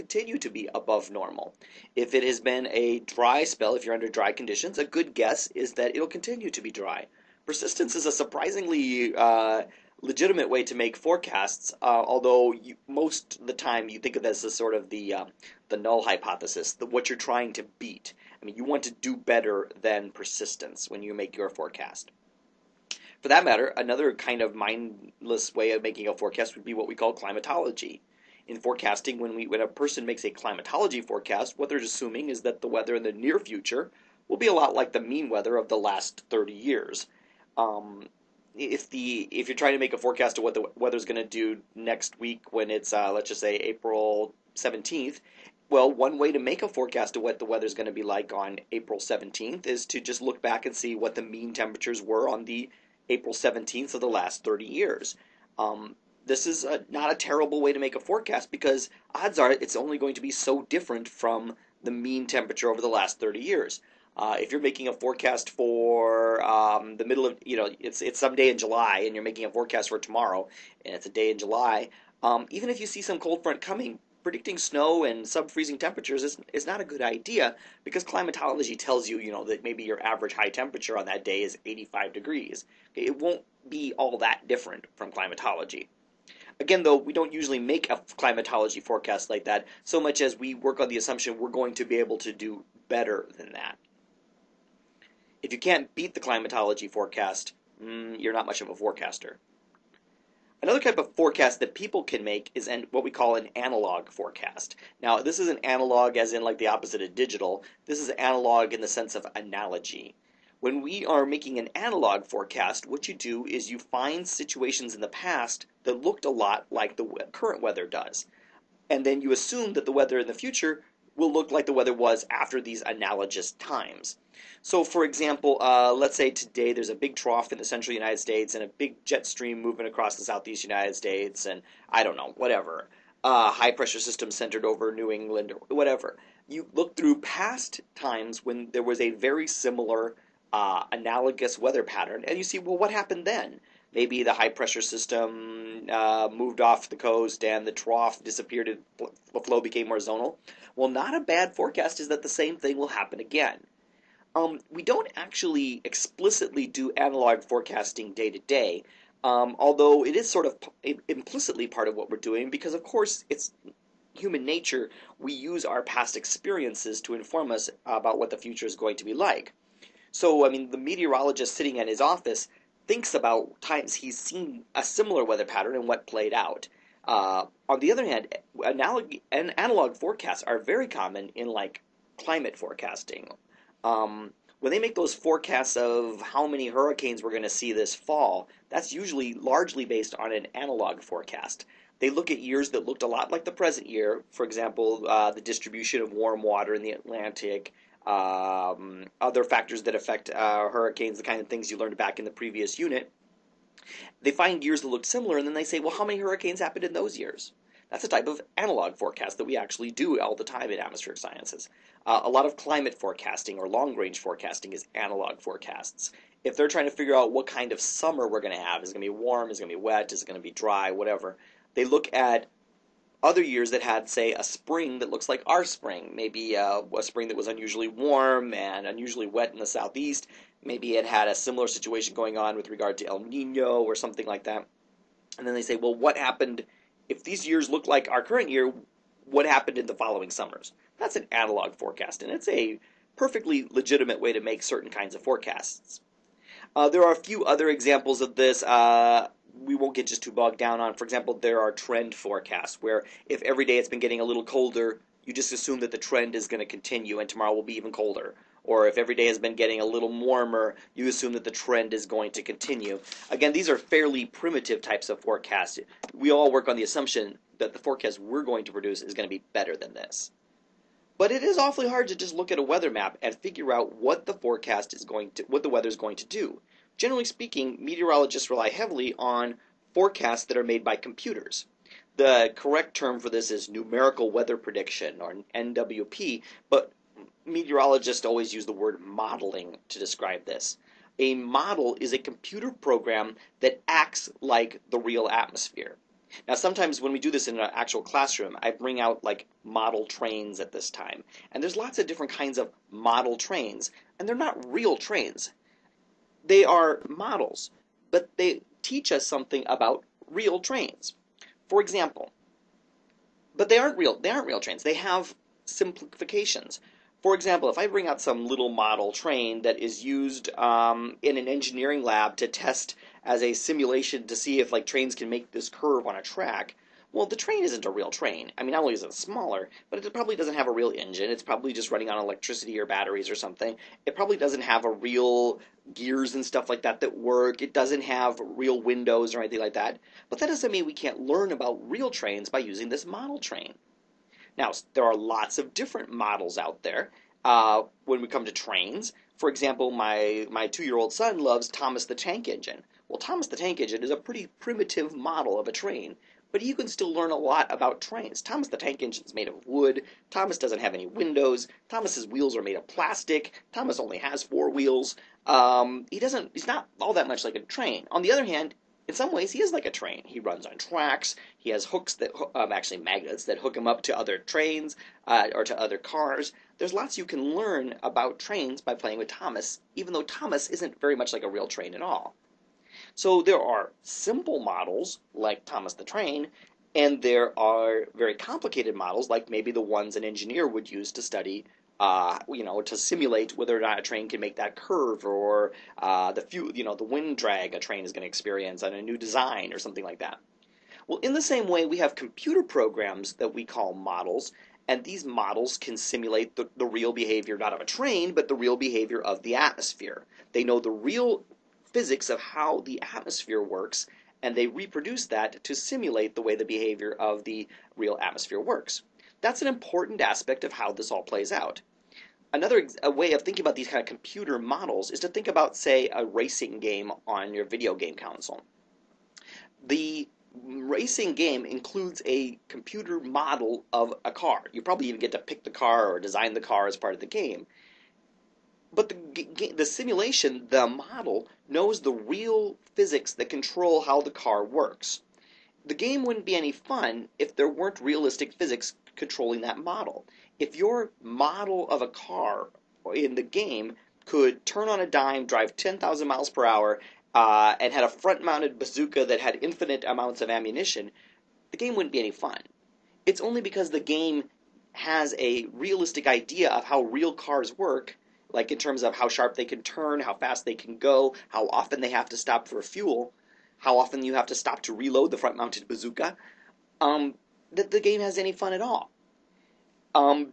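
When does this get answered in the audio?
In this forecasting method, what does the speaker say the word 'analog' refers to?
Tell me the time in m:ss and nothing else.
1:49.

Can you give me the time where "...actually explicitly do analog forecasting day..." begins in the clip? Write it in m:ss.
2:35.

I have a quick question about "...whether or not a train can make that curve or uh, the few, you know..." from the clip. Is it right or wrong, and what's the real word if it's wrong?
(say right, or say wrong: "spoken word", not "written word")
right.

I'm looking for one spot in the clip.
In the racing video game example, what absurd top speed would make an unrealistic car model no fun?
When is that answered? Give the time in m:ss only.
7:35.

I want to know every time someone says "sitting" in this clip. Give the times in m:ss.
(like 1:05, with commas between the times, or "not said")
2:51.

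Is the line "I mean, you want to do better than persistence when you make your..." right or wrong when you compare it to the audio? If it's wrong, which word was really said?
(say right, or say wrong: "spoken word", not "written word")
right.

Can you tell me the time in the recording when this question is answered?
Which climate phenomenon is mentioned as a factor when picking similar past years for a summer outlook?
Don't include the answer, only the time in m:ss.
3:53.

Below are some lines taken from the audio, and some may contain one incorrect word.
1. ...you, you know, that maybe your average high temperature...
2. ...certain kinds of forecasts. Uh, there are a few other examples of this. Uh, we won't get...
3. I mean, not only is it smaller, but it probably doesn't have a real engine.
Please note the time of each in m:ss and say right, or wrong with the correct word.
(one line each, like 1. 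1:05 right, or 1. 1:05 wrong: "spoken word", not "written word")
1. 1:19 right
2. 4:04 right
3. 5:28 right.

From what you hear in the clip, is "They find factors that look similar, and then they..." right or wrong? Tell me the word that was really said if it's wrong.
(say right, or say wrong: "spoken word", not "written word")
wrong: "years", not "factors".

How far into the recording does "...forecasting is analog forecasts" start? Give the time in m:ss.
3:34.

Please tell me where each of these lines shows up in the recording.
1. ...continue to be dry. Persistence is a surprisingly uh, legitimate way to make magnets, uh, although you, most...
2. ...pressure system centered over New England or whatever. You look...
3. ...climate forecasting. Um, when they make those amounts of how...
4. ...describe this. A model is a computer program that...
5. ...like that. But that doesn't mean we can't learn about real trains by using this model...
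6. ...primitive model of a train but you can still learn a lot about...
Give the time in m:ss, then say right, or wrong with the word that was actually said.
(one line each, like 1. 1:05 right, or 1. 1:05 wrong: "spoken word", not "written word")
1. 0:06 wrong: "forecasts", not "magnets"
2. 2:13 right
3. 3:02 wrong: "forecasts", not "amounts"
4. 4:49 right
5. 5:39 right
6. 5:54 right.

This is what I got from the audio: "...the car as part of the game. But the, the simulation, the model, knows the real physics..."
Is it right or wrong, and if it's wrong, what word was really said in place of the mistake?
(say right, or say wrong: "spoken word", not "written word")
right.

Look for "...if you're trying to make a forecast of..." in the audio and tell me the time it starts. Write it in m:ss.
0:39.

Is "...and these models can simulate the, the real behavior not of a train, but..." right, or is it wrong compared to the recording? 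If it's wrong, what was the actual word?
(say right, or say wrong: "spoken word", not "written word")
right.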